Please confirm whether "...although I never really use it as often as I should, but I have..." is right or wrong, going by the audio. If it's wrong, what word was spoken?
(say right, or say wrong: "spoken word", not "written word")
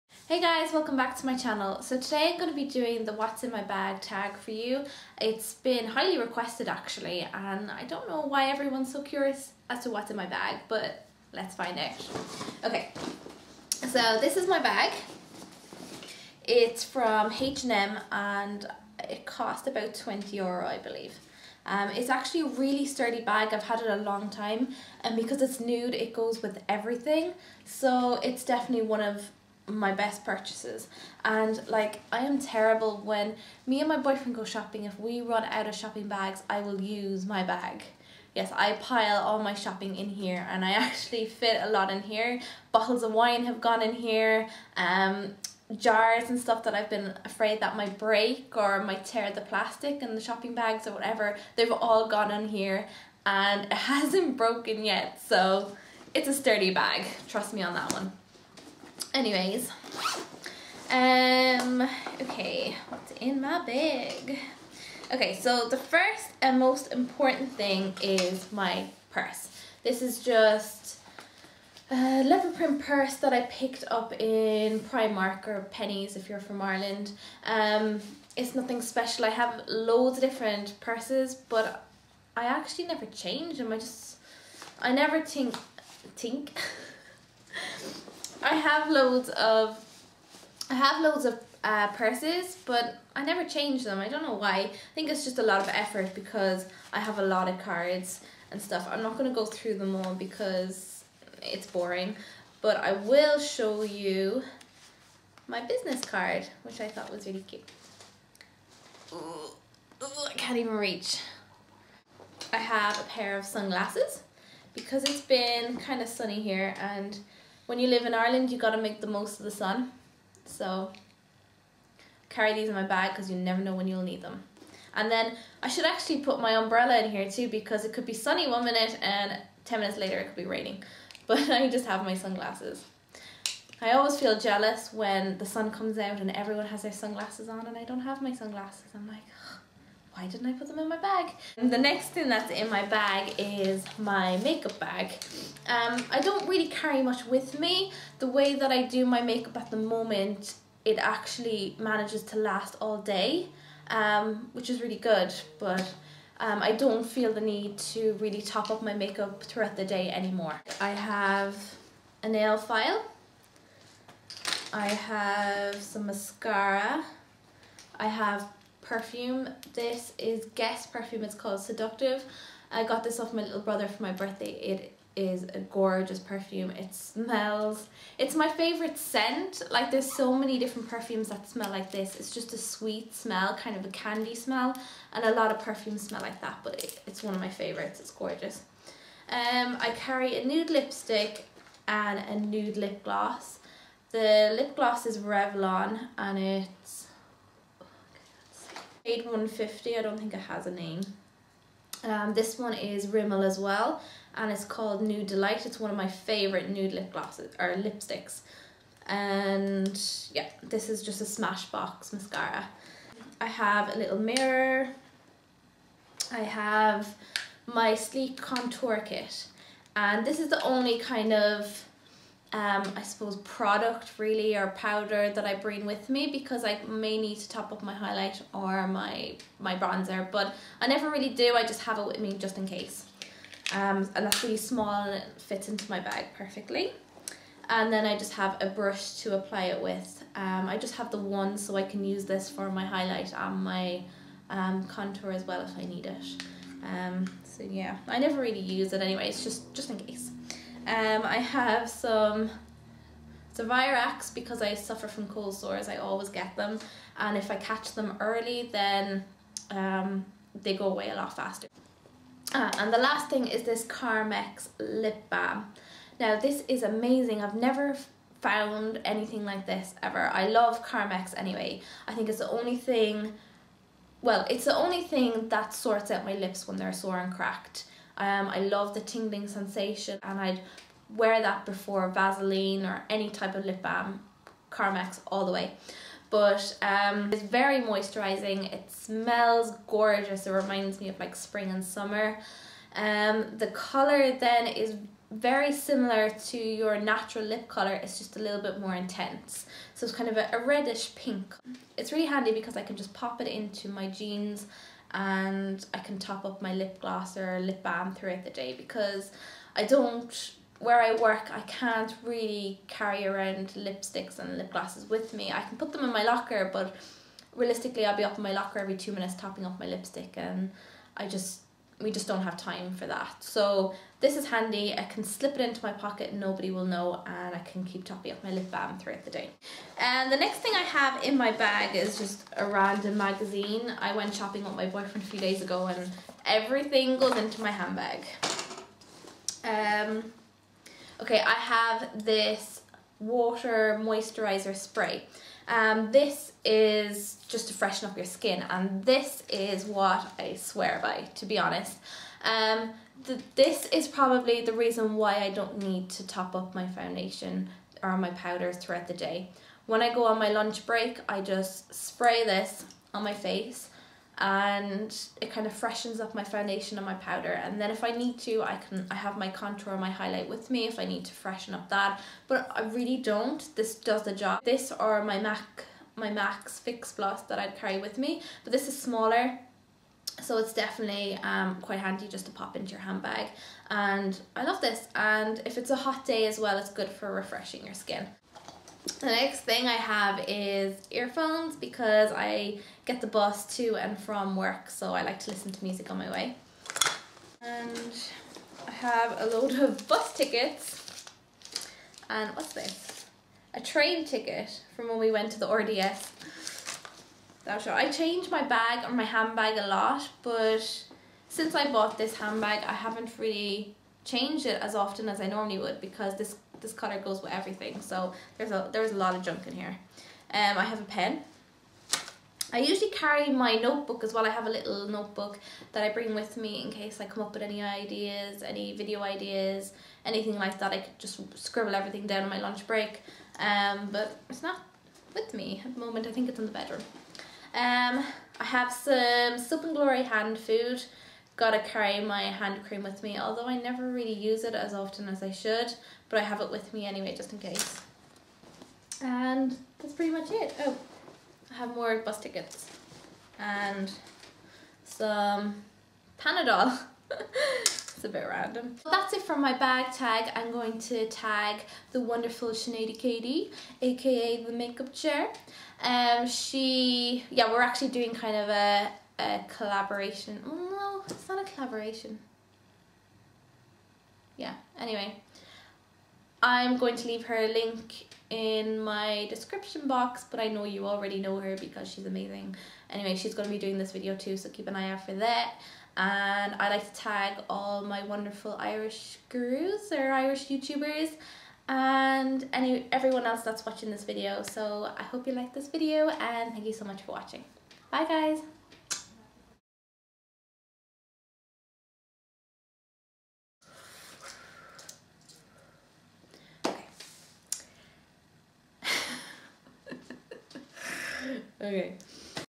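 right.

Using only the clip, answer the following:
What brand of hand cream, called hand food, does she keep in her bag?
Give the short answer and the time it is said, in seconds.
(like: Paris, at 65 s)
Soap and Glory, at 439 s.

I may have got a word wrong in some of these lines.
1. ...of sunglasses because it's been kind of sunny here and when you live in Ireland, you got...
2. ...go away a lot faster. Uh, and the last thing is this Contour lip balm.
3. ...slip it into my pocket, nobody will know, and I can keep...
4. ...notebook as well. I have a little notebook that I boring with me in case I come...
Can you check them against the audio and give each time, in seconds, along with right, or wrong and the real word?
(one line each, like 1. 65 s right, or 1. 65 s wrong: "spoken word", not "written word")
1. 113 s right
2. 260 s wrong: "Carmex", not "Contour"
3. 325 s right
4. 423 s wrong: "bring", not "boring".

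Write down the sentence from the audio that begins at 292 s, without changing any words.
Um, the color then is very similar to your natural lip color.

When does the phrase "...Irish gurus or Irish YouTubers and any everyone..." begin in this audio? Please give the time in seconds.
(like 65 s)
488 s.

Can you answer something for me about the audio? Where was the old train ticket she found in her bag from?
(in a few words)
RDS.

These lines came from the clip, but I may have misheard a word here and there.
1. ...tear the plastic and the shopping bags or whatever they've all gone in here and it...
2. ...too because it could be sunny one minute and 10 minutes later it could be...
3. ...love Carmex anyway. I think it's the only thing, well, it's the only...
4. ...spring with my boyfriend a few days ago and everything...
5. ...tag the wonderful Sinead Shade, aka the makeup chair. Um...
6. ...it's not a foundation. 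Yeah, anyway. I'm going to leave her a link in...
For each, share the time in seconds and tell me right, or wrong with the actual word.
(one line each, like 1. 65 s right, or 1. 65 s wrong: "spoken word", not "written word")
1. 49 s right
2. 127 s right
3. 270 s right
4. 334 s wrong: "shopping", not "spring"
5. 461 s wrong: "Katie", not "Shade"
6. 471 s wrong: "collaboration", not "foundation".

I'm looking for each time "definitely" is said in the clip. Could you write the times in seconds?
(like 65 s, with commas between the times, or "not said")
28 s, 380 s.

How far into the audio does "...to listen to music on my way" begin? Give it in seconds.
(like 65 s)
395 s.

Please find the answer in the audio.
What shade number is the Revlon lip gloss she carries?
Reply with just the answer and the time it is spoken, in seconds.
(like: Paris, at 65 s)
150, at 199 s.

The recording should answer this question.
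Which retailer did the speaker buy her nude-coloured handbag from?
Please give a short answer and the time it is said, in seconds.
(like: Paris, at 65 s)
H&M, at 17 s.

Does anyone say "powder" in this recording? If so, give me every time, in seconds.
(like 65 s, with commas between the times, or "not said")
224 s, 358 s, 367 s.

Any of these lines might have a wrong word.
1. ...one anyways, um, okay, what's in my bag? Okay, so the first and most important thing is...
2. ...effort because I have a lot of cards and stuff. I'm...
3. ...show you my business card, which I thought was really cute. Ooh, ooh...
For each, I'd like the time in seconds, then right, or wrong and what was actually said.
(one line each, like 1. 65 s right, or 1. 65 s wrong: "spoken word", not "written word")
1. 57 s right
2. 95 s right
3. 103 s right.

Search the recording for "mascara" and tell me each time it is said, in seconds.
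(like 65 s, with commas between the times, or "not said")
166 s, 212 s.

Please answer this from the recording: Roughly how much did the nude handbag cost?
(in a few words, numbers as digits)
20 euro.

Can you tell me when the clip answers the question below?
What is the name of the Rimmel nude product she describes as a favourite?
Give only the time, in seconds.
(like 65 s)
205 s.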